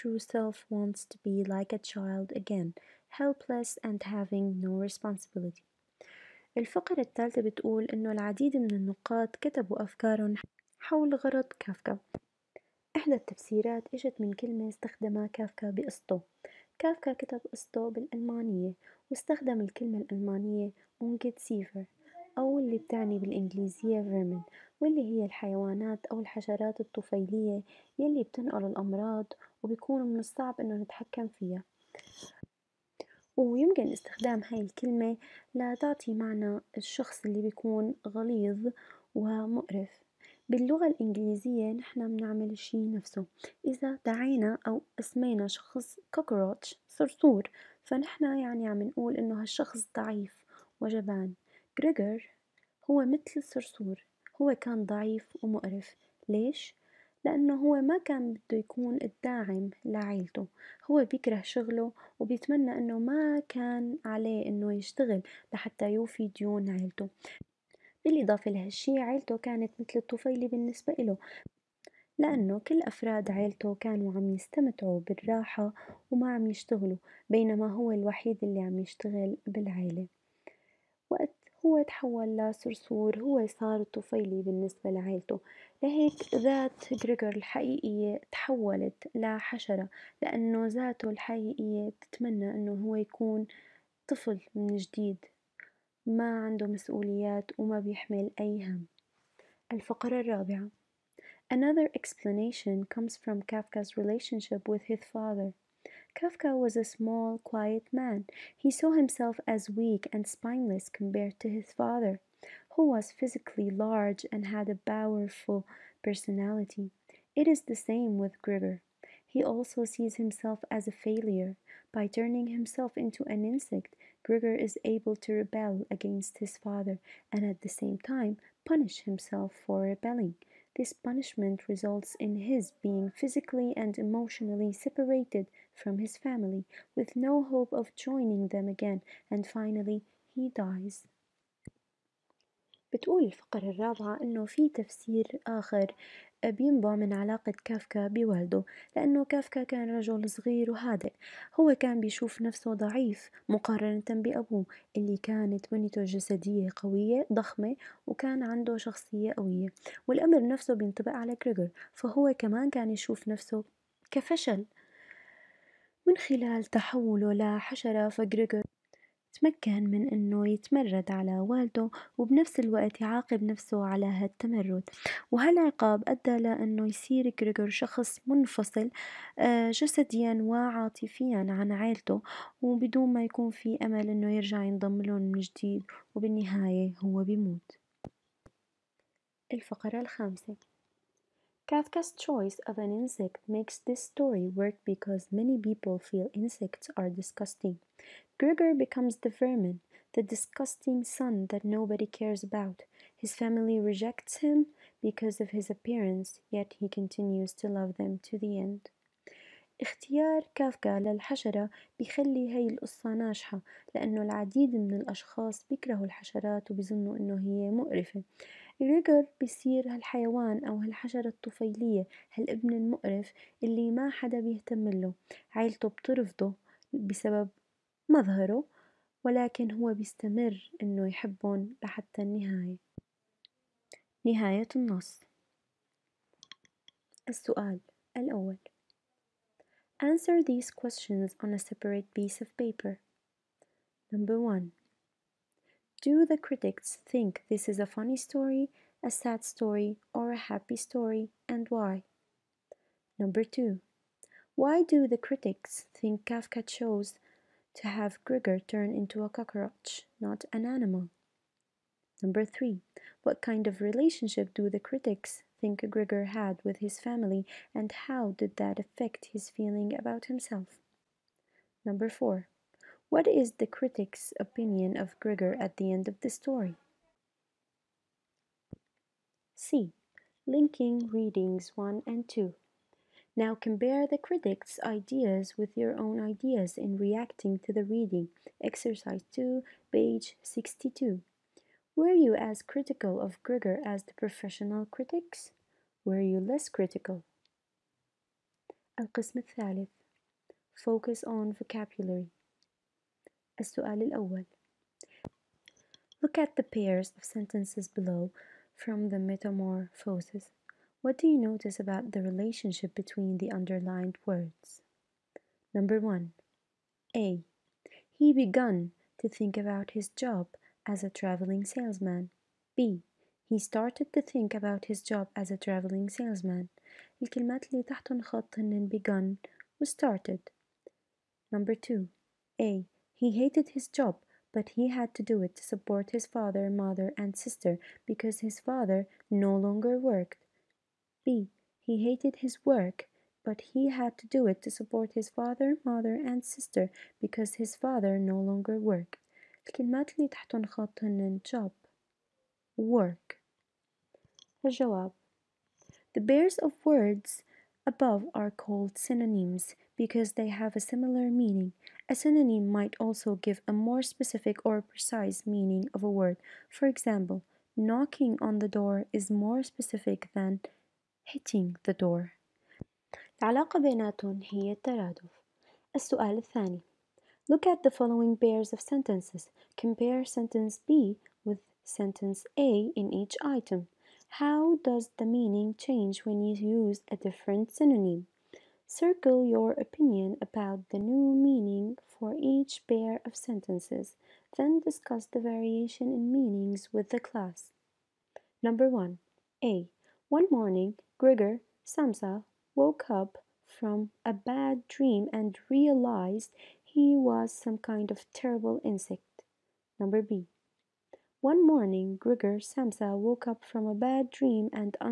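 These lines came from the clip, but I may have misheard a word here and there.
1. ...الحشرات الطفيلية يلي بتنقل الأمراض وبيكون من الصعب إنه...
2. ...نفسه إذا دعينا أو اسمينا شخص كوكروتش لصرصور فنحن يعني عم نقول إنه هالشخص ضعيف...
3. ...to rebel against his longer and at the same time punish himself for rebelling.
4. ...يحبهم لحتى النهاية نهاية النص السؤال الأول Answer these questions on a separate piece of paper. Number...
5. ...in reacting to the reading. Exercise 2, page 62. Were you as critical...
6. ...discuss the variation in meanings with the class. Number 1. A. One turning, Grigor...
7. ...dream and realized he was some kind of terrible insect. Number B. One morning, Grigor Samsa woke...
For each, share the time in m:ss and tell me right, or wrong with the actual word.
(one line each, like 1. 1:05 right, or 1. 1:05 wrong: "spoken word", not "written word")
1. 0:26 right
2. 0:42 wrong: "صرصور", not "لصرصور"
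3. 2:05 wrong: "father", not "longer"
4. 3:51 right
5. 4:46 right
6. 6:34 wrong: "morning", not "turning"
7. 6:44 right.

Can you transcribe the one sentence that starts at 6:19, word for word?
Compare sentence B with sentence A in each item.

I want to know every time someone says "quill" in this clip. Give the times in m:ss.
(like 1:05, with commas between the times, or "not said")
not said.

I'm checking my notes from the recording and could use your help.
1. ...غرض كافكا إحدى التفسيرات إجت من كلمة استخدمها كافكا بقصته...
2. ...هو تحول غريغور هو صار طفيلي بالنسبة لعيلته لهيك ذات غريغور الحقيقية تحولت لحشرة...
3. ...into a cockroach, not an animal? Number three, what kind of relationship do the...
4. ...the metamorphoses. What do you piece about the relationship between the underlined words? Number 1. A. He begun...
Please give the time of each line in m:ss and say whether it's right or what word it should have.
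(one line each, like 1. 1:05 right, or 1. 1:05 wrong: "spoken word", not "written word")
1. 0:11 right
2. 1:21 wrong: "لصرصور", not "غريغور"
3. 4:18 right
4. 5:09 wrong: "notice", not "piece".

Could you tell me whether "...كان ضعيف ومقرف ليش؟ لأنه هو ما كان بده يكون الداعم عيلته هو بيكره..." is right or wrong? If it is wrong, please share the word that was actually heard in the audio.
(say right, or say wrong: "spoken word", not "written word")
wrong: "لعيلته", not "عيلته".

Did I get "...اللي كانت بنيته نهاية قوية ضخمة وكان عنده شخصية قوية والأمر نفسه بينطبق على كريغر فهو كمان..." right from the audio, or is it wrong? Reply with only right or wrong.
wrong.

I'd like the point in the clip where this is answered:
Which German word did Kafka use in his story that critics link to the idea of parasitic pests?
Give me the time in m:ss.
0:21.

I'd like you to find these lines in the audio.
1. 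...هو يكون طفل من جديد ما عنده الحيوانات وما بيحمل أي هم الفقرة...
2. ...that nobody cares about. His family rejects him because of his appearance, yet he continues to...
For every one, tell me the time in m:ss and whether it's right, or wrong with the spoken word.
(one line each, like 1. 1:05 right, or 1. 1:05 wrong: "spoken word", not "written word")
1. 1:32 wrong: "مسؤوليات", not "الحيوانات"
2. 3:21 right.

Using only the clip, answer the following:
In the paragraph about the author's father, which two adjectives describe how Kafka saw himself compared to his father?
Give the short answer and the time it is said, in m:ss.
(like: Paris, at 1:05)
weak and spineless, at 1:49.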